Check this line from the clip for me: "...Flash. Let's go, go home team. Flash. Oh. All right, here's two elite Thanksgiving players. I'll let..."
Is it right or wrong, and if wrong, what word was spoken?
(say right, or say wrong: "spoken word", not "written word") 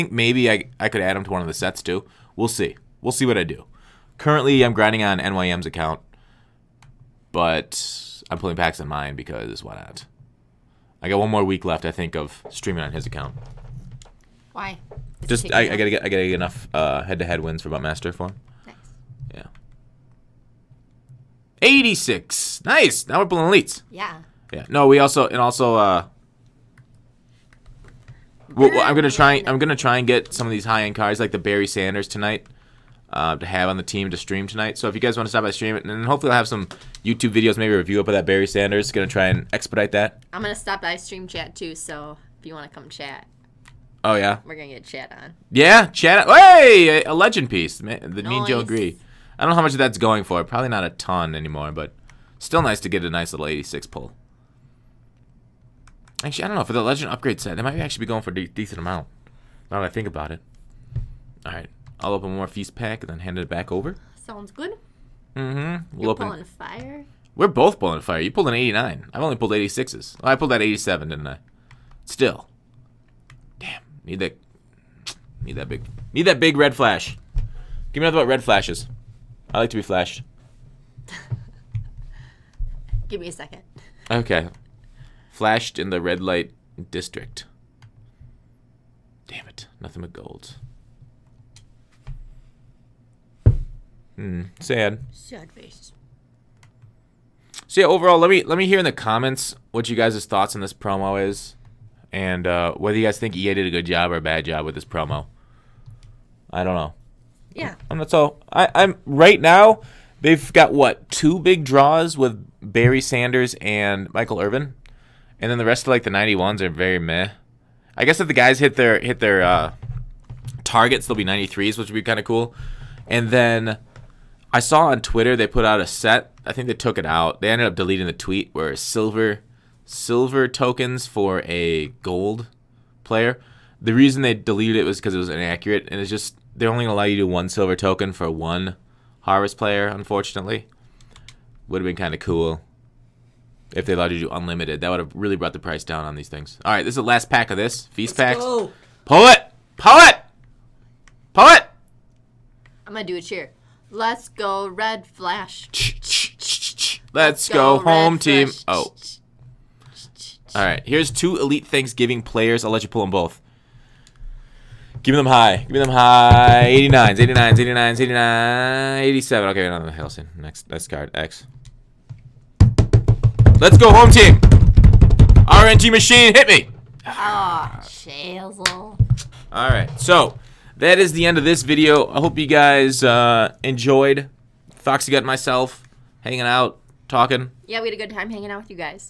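right.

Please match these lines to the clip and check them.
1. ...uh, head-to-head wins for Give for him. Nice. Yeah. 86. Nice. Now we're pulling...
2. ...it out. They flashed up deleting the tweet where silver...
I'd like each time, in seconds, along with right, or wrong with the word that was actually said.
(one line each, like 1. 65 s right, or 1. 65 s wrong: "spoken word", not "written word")
1. 16 s wrong: "Buttmaster", not "Give"
2. 126 s wrong: "ended", not "flashed".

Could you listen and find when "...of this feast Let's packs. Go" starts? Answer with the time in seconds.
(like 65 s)
147 s.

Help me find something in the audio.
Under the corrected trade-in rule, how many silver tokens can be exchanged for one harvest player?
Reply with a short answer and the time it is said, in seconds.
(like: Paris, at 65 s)
1, at 137 s.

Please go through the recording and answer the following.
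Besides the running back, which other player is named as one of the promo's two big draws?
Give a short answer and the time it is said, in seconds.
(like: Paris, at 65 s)
Michael Irvin, at 114 s.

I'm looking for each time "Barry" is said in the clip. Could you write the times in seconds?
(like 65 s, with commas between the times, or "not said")
31 s, 38 s, 112 s.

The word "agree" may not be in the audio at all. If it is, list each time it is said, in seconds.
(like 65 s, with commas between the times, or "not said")
48 s.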